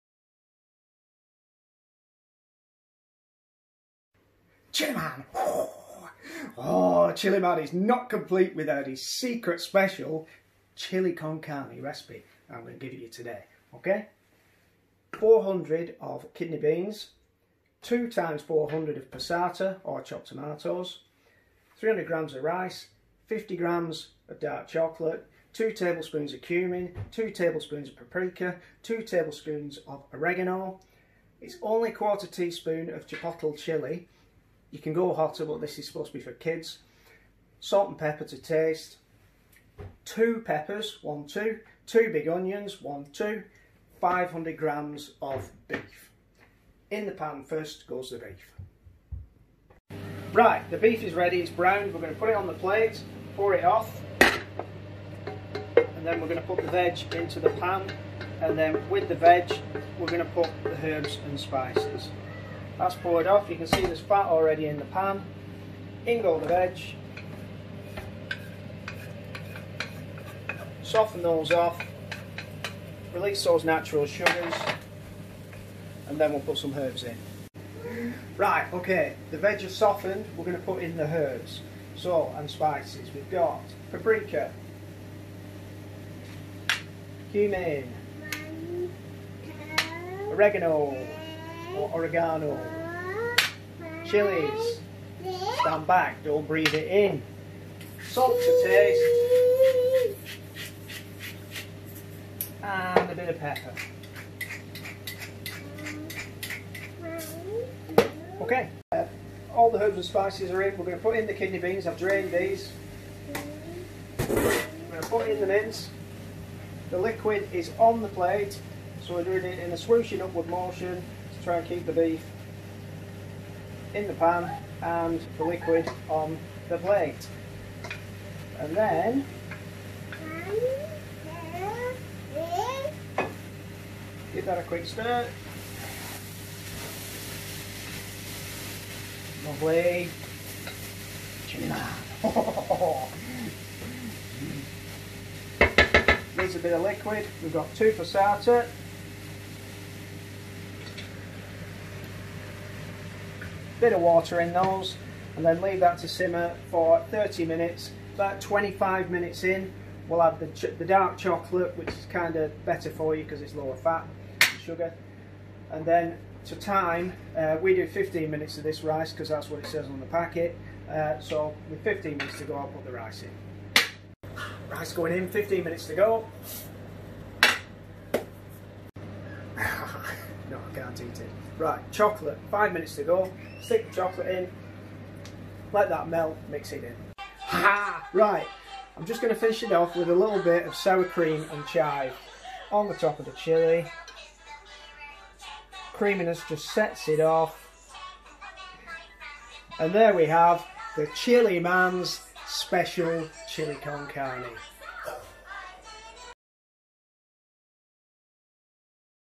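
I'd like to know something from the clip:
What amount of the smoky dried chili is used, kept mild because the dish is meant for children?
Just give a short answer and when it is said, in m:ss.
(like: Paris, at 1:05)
1/4 teaspoon, at 0:31.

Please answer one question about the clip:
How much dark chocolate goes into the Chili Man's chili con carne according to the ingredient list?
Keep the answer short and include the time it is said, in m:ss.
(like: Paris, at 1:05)
50 grams, at 0:23.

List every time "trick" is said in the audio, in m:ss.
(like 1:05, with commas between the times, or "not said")
not said.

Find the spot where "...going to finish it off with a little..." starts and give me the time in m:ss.
3:09.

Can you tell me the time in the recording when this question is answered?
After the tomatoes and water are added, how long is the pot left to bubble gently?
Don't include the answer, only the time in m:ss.
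2:37.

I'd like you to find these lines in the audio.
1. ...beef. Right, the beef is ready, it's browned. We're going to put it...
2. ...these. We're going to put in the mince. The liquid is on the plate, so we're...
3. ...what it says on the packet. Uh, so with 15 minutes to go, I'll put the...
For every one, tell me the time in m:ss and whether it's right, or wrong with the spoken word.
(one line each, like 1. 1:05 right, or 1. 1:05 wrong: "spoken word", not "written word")
1. 0:48 right
2. 1:52 right
3. 2:49 right.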